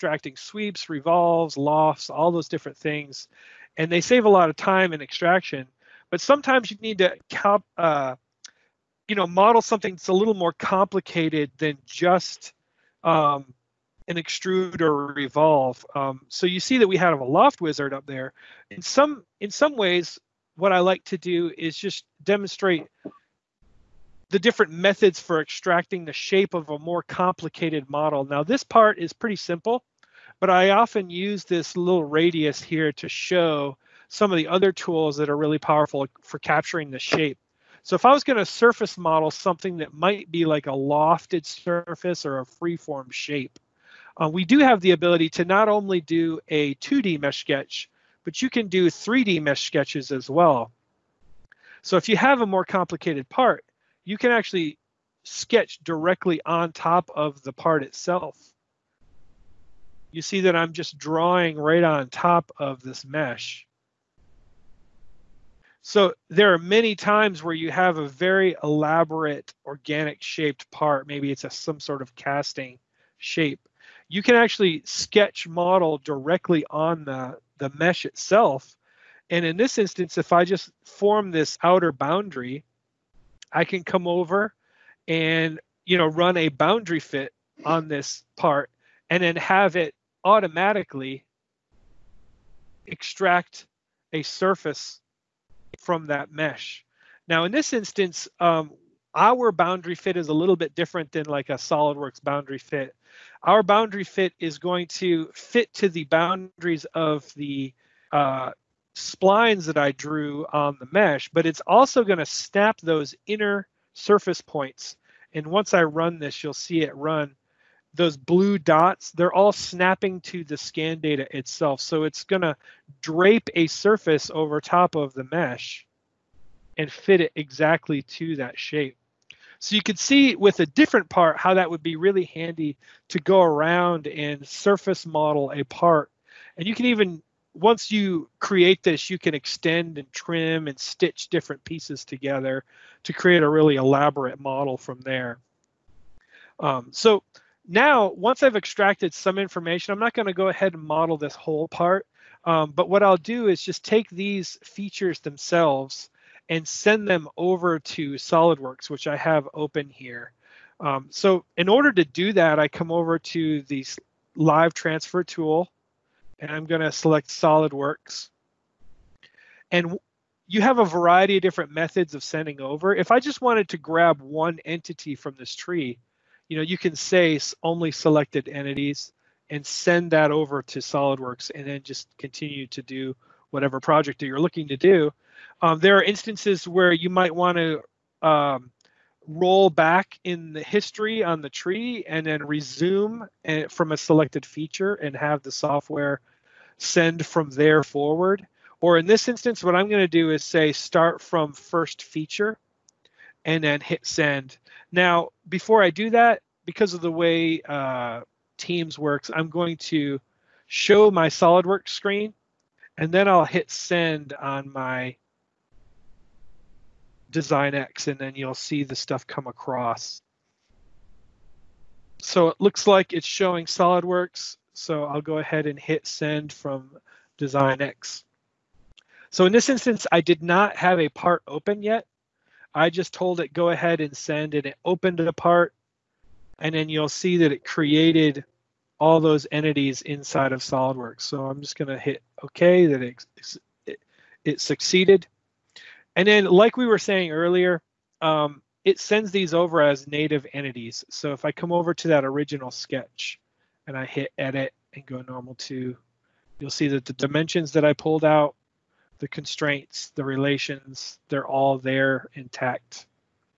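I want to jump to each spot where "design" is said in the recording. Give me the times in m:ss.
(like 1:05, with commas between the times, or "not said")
3:37, 3:47.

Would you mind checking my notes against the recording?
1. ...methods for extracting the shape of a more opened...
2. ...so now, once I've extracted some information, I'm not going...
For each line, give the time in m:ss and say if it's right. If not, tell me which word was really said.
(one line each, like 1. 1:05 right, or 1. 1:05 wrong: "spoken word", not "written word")
1. 0:24 wrong: "complicated", not "opened"
2. 2:26 right.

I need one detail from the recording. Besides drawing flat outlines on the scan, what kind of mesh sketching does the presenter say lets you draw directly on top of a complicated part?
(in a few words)
3D mesh sketches.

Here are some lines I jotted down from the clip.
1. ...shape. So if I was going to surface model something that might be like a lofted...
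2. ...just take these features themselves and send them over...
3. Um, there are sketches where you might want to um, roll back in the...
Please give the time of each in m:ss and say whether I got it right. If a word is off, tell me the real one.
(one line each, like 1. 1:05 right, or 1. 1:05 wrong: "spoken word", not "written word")
1. 0:36 right
2. 2:33 right
3. 3:05 wrong: "instances", not "sketches".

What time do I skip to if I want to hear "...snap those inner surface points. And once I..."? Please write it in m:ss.
1:52.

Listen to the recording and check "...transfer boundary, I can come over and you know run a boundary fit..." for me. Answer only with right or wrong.
wrong.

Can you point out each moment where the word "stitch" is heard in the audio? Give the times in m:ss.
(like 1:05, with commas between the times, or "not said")
2:20.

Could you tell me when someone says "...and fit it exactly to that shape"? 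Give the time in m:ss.
2:06.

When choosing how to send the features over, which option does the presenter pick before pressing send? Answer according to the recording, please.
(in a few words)
Start from first feature.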